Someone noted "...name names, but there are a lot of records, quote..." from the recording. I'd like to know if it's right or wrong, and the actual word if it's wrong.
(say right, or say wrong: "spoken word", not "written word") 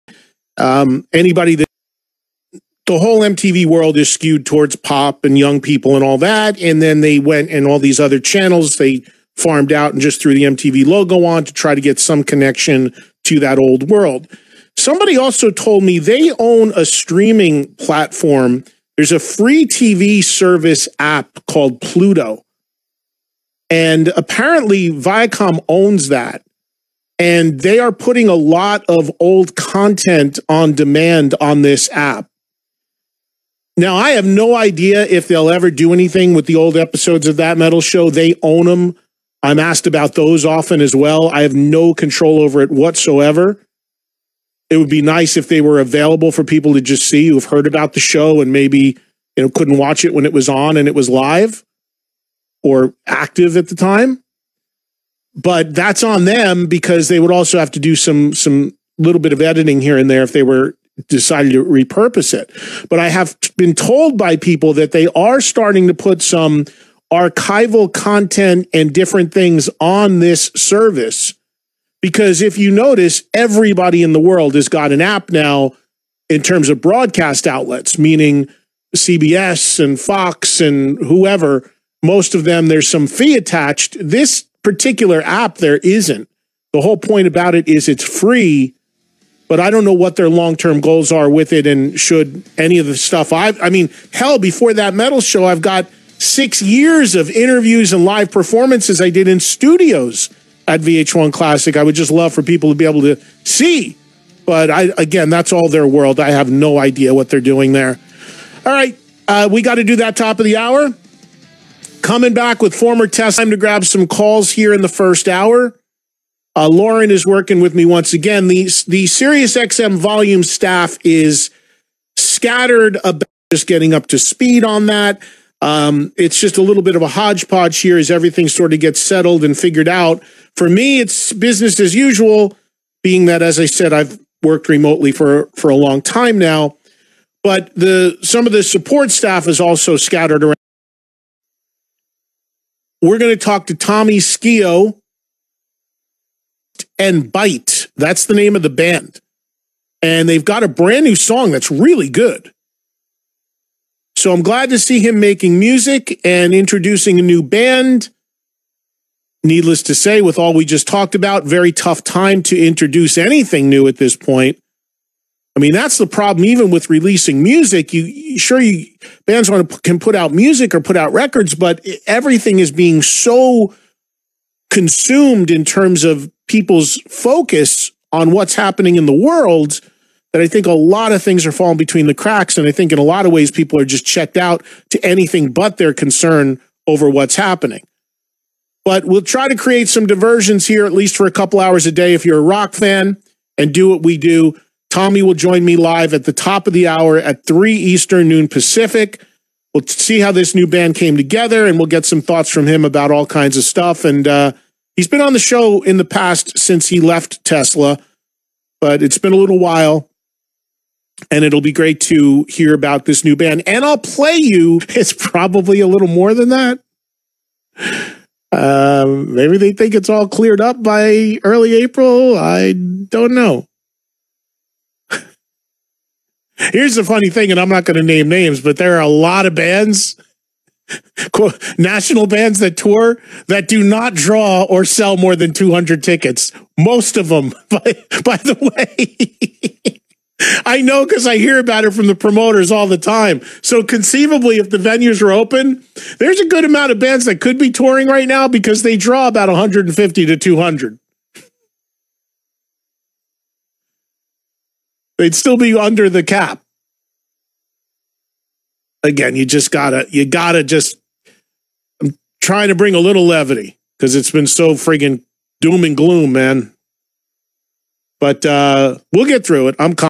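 wrong: "bands", not "records".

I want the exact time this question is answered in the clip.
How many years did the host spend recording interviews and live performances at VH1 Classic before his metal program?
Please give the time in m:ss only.
1:36.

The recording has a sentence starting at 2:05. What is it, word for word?
Um, it's just a little bit of a hodgepodge here as everything sort of gets settled and figured out.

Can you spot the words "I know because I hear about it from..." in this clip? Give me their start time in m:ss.
4:00.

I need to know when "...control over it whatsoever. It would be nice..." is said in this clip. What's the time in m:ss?
0:41.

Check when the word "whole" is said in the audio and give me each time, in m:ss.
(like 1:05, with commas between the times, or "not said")
0:02, 1:26.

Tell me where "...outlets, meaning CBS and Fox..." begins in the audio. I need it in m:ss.
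1:17.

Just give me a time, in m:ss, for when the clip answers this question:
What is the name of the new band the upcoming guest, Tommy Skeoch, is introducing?
2:27.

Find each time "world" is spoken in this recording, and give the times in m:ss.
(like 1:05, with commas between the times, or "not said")
0:03, 0:13, 1:14, 1:45, 2:59.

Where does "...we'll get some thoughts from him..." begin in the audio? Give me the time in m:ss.
3:21.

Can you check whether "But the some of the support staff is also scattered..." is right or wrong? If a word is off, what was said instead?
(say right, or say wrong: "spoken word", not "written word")
right.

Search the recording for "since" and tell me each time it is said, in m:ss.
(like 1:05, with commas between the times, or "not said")
3:26.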